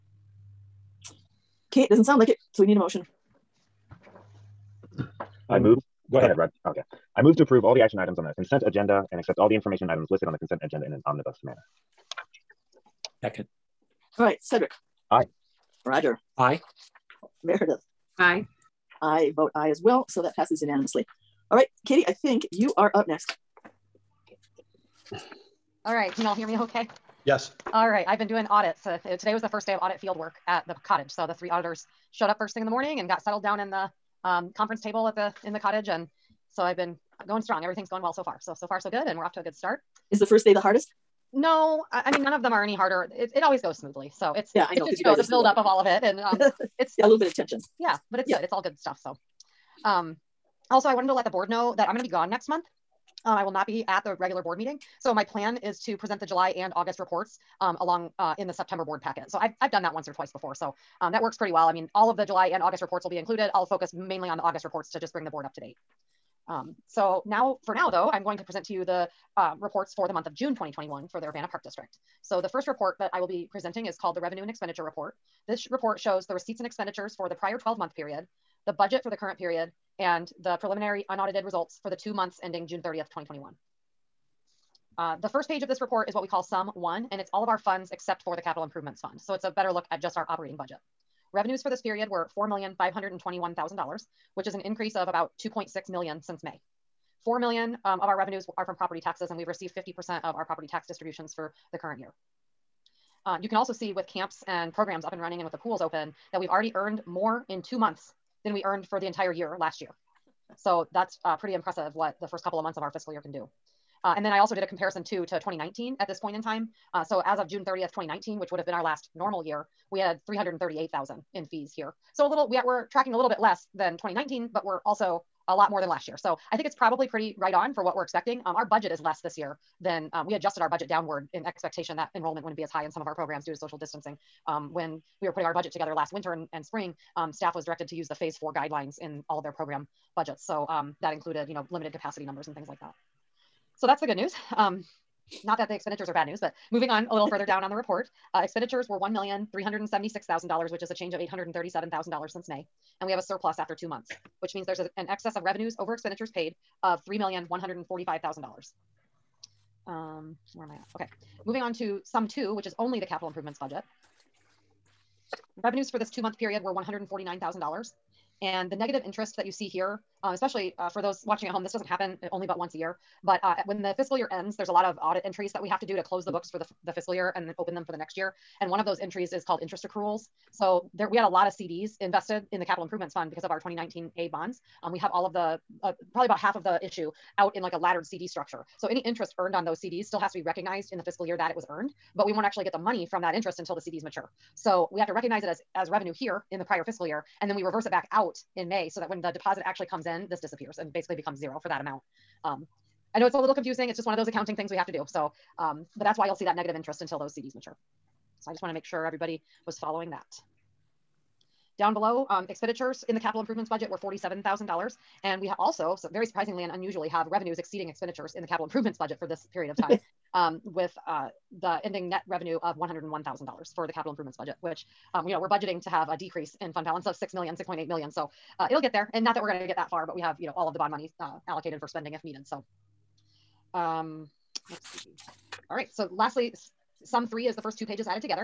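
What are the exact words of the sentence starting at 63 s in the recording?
I'll focus mainly on the August reports to just bring the board up to date.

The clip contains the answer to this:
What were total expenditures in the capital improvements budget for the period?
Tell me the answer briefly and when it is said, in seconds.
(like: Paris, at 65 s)
$47,000, at 213 s.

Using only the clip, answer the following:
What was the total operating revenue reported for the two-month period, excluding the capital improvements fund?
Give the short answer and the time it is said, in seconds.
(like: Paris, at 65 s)
$4,521,000, at 92 s.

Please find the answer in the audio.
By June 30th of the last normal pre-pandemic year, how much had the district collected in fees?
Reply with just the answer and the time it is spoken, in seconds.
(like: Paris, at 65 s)
338,000, at 120 s.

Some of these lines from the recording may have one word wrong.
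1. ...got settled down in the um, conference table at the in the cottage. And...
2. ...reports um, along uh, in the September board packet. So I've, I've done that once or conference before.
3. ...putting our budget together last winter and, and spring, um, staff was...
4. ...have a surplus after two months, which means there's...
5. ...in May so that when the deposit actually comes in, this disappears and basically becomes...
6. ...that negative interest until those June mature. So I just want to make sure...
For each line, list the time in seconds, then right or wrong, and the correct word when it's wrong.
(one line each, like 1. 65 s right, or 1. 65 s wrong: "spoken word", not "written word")
1. 33 s right
2. 56 s wrong: "twice", not "conference"
3. 135 s right
4. 153 s right
5. 198 s right
6. 206 s wrong: "CDs", not "June".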